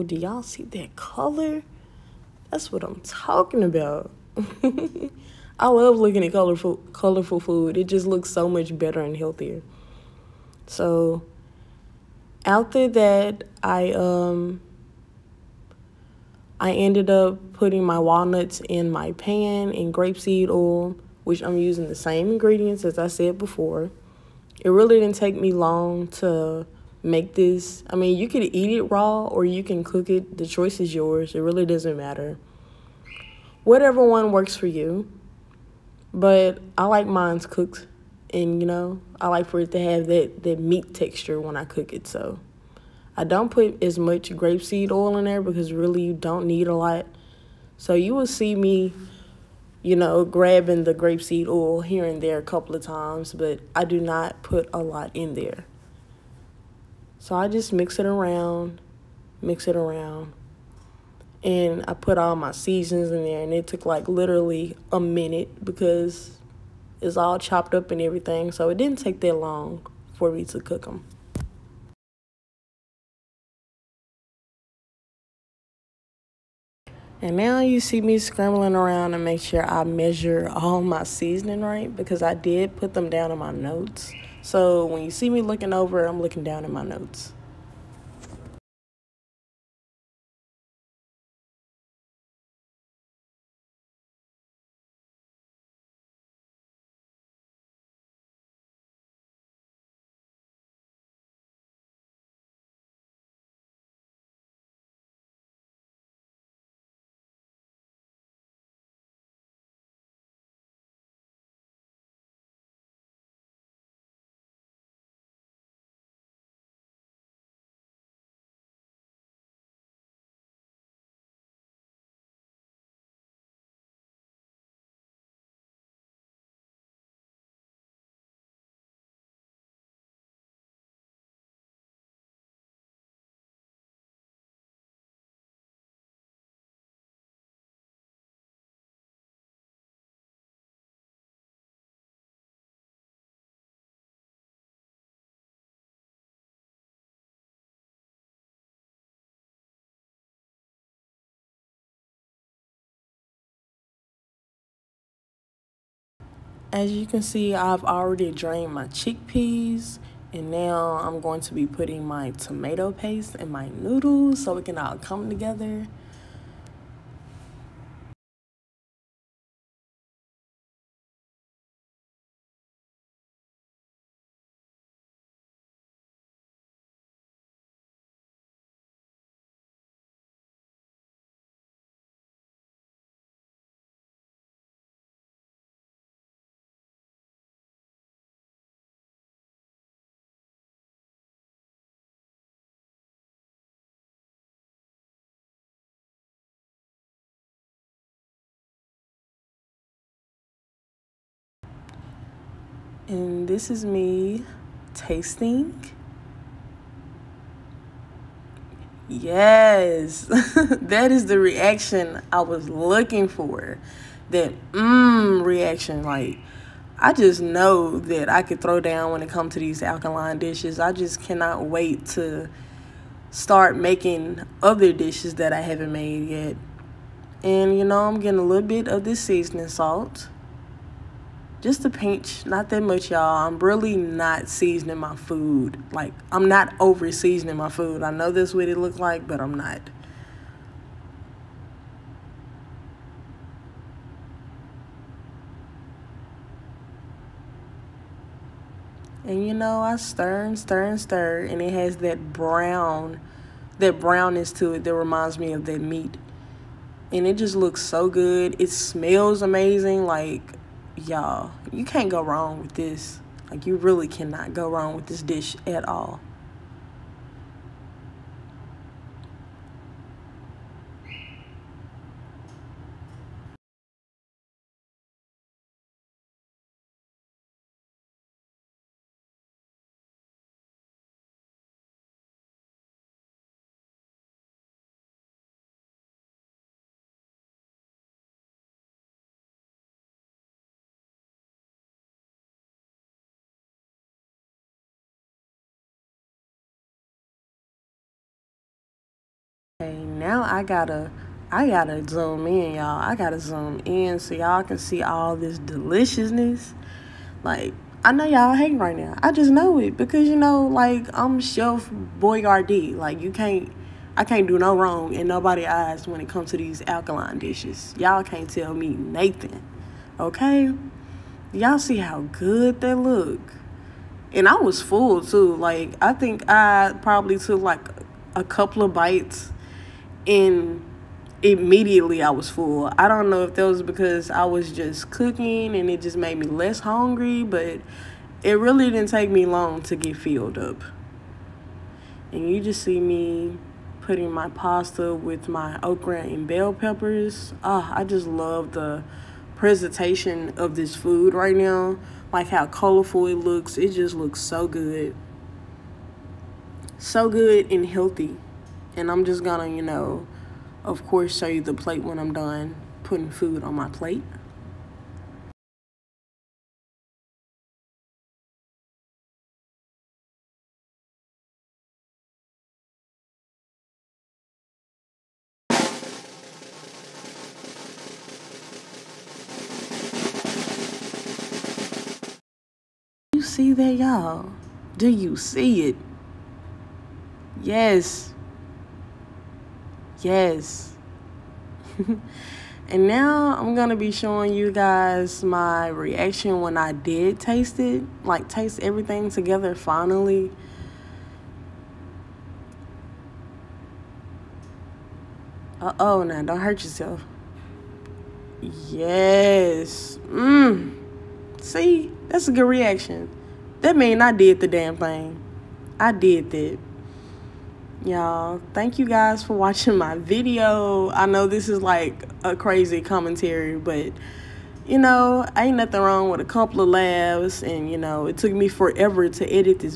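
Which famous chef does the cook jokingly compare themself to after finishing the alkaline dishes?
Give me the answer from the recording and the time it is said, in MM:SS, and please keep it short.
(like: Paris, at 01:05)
Chef Boyardee, at 05:11.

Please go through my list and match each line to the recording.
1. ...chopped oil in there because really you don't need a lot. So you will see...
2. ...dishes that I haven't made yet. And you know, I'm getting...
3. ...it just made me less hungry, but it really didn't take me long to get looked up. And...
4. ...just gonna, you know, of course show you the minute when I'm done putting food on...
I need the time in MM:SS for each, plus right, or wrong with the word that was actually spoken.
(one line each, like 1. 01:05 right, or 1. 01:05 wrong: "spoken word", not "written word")
1. 00:44 wrong: "grapeseed", not "chopped"
2. 03:44 right
3. 05:35 wrong: "filled", not "looked"
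4. 05:59 wrong: "plate", not "minute".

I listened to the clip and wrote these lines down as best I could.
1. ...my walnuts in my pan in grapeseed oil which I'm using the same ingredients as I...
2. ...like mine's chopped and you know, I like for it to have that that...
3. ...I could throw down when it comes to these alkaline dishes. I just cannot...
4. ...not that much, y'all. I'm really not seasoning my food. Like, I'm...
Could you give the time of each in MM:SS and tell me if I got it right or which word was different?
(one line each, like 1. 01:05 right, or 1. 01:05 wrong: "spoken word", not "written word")
1. 00:17 right
2. 00:36 wrong: "cooked", not "chopped"
3. 03:38 right
4. 03:52 right.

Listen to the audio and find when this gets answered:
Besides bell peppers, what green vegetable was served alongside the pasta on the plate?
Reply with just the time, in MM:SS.
05:45.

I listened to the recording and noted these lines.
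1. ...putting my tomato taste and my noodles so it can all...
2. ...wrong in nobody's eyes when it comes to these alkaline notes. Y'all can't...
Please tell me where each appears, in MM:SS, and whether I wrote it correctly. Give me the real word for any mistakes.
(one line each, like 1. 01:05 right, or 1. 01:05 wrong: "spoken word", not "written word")
1. 02:41 wrong: "paste", not "taste"
2. 05:14 wrong: "dishes", not "notes".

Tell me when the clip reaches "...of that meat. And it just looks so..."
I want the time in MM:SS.
04:15.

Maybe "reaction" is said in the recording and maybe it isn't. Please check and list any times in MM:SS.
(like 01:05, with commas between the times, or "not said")
03:31, 03:35, 06:35, 06:52.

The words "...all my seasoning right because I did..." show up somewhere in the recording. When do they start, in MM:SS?
01:20.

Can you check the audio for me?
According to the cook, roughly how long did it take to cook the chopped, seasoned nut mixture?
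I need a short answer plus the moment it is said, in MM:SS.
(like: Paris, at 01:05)
a minute, at 01:04.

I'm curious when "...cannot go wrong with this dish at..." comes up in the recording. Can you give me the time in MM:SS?
04:24.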